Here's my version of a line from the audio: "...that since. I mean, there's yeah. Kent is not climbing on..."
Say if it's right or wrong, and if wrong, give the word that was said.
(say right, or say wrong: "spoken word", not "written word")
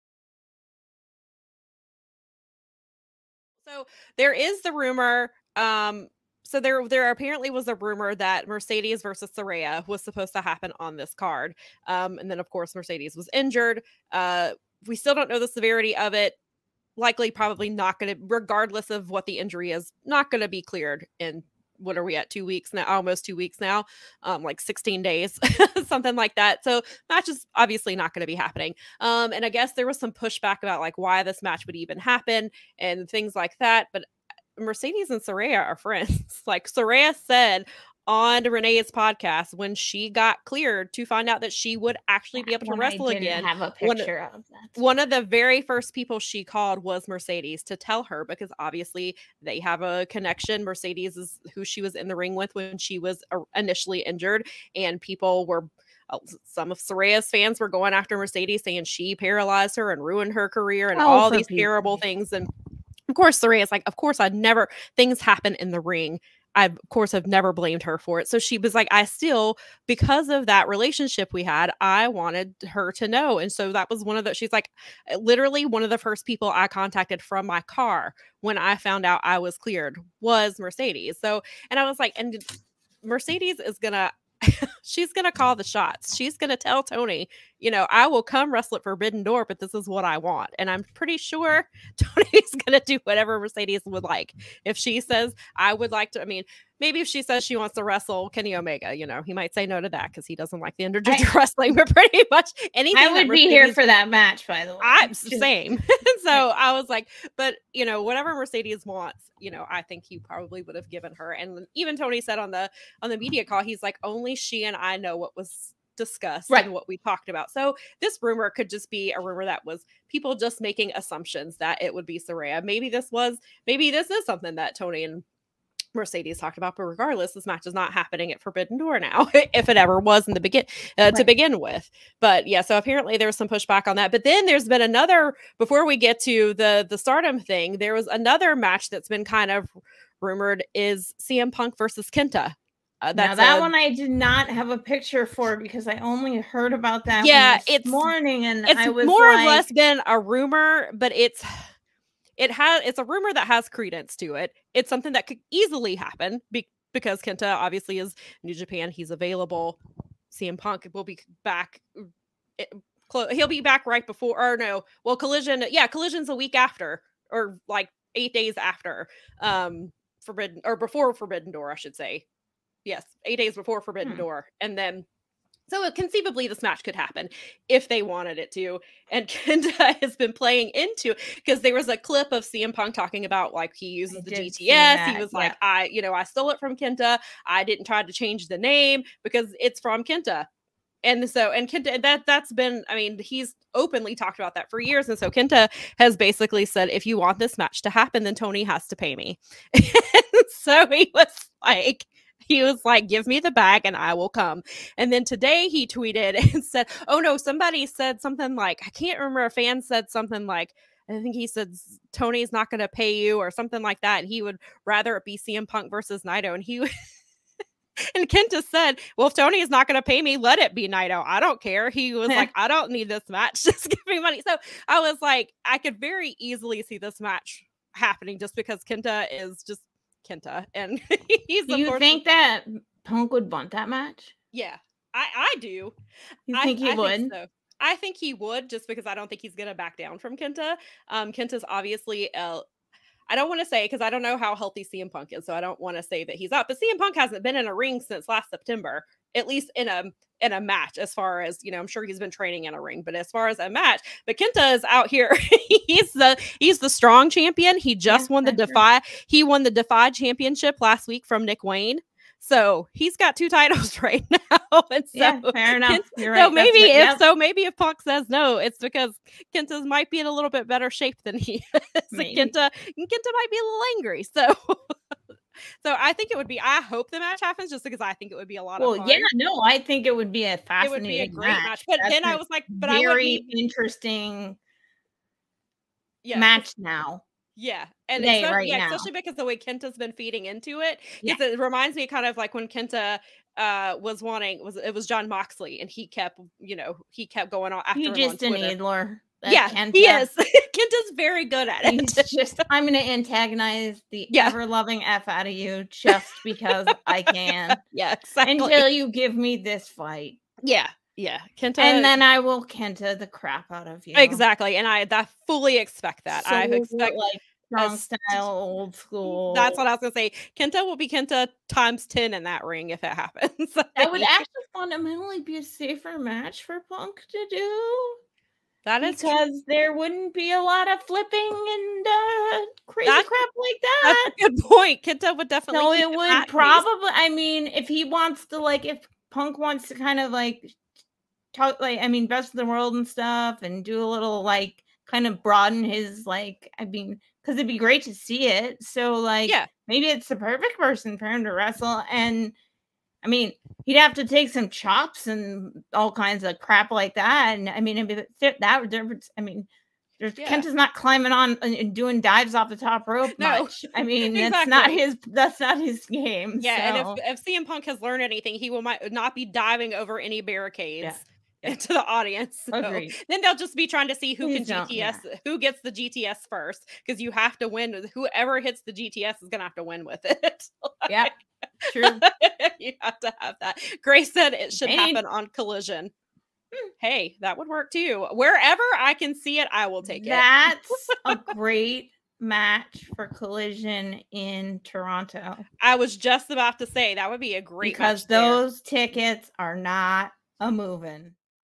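wrong: "difference", not "since".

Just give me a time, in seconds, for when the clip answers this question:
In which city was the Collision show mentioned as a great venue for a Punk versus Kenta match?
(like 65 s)
394 s.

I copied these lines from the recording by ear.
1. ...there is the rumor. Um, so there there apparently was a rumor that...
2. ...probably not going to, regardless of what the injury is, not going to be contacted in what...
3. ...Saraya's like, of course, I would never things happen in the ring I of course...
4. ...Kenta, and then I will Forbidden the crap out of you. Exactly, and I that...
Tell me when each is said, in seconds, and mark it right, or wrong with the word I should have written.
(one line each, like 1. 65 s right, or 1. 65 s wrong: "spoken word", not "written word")
1. 4 s right
2. 17 s wrong: "cleared", not "contacted"
3. 63 s right
4. 311 s wrong: "Kenta", not "Forbidden".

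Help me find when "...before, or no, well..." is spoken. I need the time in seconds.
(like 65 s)
164 s.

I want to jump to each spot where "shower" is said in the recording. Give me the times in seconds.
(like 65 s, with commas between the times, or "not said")
not said.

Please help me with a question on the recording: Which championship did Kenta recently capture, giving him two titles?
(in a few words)
Defy championship.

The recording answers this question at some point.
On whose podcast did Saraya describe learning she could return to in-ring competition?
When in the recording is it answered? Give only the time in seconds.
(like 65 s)
38 s.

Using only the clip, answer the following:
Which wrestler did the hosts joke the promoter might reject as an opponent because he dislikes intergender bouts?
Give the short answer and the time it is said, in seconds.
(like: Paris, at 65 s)
Kenny Omega, at 98 s.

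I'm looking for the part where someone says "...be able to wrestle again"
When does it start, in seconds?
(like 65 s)
42 s.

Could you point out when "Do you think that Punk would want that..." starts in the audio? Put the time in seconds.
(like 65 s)
231 s.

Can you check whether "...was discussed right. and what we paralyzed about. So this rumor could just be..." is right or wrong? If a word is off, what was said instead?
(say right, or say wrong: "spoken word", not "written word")
wrong: "talked", not "paralyzed".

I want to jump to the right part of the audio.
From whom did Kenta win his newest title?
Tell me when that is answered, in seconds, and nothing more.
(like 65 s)
261 s.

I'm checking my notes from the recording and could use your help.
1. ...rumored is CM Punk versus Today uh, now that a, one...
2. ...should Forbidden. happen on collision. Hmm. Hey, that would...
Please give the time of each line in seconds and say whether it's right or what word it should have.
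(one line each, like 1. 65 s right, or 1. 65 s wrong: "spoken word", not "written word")
1. 140 s wrong: "Kenta", not "Today"
2. 384 s wrong: "Dang", not "Forbidden".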